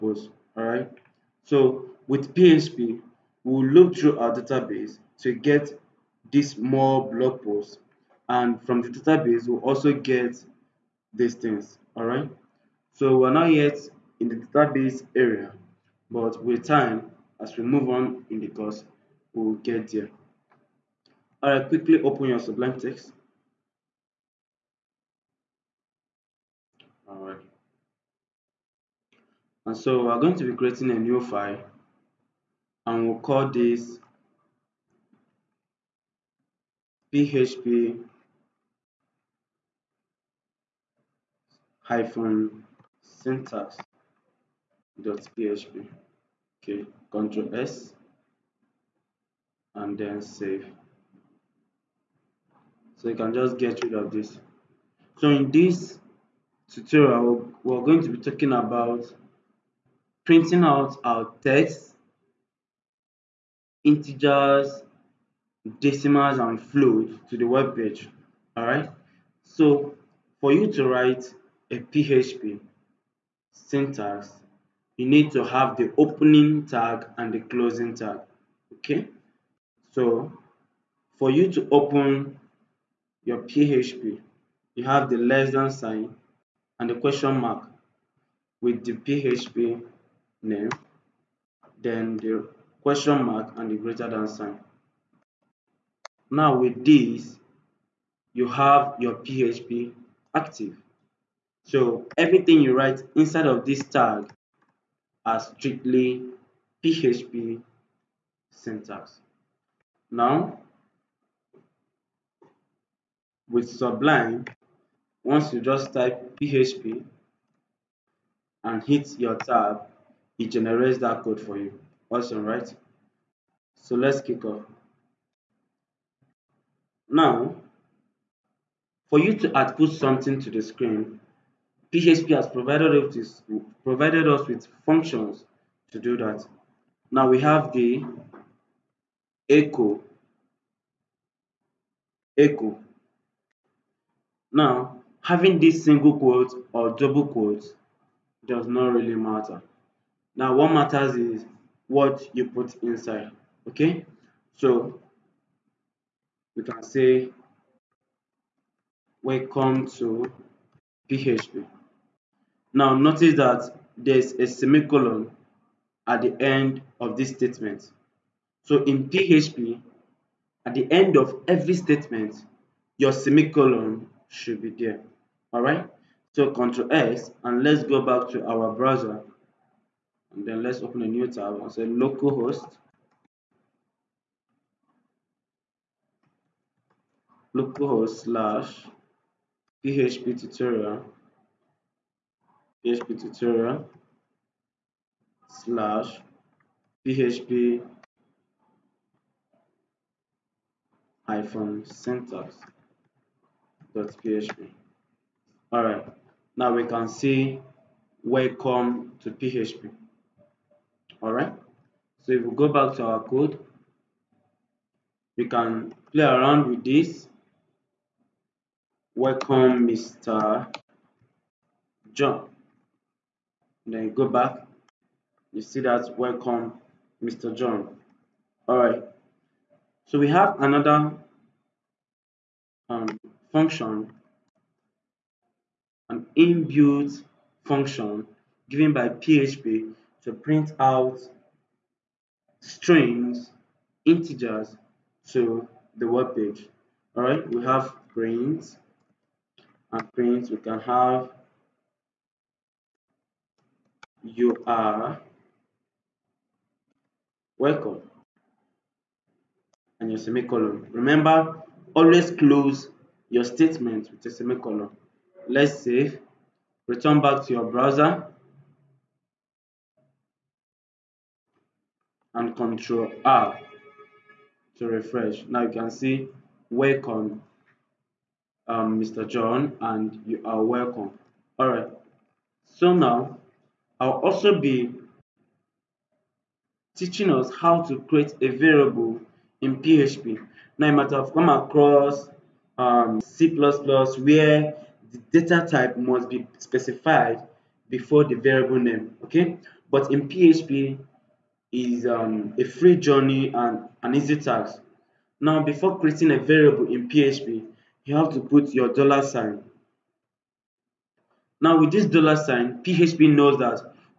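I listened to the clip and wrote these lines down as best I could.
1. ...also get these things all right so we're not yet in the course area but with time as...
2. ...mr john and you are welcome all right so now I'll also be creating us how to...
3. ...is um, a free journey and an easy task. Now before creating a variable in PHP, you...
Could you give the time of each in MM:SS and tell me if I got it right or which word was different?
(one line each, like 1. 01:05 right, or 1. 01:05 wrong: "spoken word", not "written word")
1. 00:09 wrong: "database", not "course"
2. 04:39 wrong: "teaching", not "creating"
3. 05:01 right.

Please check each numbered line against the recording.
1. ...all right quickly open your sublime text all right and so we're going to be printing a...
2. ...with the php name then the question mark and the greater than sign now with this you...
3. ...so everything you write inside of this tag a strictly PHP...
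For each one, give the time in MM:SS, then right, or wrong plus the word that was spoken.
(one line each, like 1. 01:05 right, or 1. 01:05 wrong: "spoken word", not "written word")
1. 00:21 wrong: "creating", not "printing"
2. 01:28 right
3. 01:41 right.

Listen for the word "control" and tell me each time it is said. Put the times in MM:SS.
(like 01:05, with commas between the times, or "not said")
00:47, 02:56, 04:32.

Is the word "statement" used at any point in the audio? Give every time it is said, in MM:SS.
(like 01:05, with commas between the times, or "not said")
02:47, 02:51, 04:23.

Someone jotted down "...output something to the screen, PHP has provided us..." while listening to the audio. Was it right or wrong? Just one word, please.
right.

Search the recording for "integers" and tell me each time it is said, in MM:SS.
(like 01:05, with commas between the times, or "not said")
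01:03, 04:04.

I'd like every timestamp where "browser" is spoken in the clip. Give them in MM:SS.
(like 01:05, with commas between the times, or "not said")
02:58, 04:27.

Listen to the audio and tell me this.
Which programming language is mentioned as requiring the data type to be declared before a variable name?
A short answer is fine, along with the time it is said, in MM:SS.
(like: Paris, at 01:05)
C++, at 04:53.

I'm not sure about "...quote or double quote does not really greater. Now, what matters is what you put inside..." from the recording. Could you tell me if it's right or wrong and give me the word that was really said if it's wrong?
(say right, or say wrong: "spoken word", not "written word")
wrong: "matter", not "greater".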